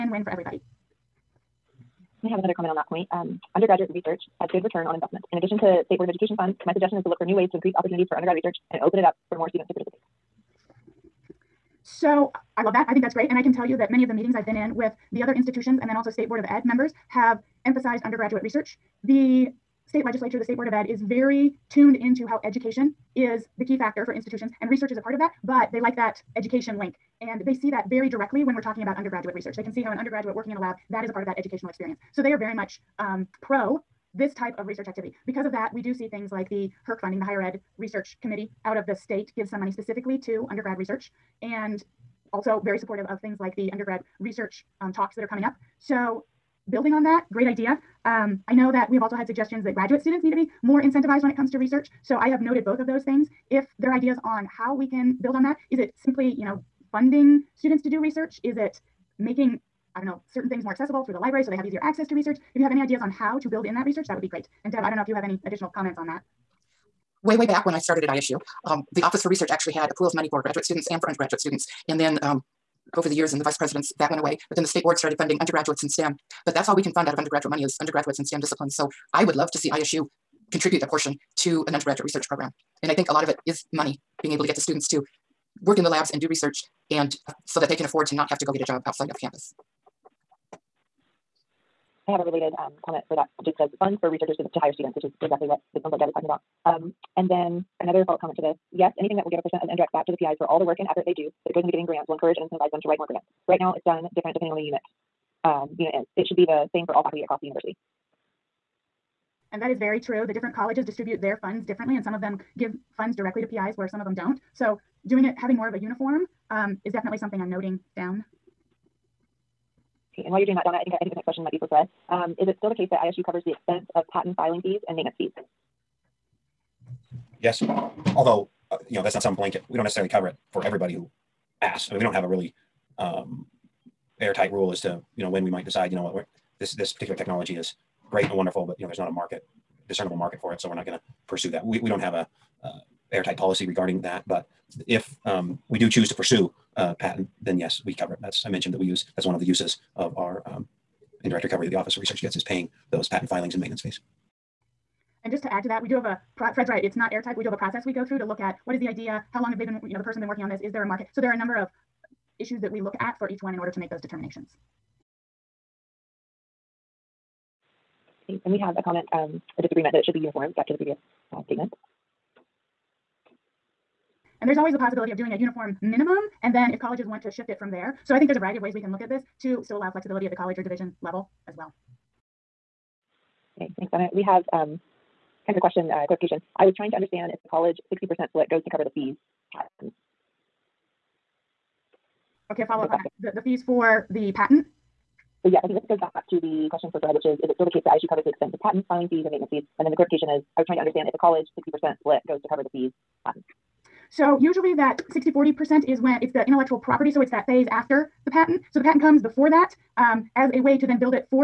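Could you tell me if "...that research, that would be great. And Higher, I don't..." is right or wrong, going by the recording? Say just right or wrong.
wrong.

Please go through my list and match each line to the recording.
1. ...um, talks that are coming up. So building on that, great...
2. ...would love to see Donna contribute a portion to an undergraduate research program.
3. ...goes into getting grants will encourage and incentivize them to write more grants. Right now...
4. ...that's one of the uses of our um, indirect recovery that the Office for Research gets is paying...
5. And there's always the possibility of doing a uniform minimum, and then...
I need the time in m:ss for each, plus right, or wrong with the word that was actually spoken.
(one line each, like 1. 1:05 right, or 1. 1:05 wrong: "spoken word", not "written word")
1. 0:44 right
2. 1:19 wrong: "ISU", not "Donna"
3. 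1:41 right
4. 2:29 right
5. 2:54 right.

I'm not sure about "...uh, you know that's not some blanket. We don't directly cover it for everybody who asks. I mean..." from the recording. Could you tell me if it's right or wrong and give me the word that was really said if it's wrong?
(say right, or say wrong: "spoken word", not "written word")
wrong: "necessarily", not "directly".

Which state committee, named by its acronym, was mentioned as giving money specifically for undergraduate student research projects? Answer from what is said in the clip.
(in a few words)
HERC.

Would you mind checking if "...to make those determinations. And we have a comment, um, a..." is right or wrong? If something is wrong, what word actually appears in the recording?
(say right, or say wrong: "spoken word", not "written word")
right.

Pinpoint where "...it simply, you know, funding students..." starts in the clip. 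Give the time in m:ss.
0:55.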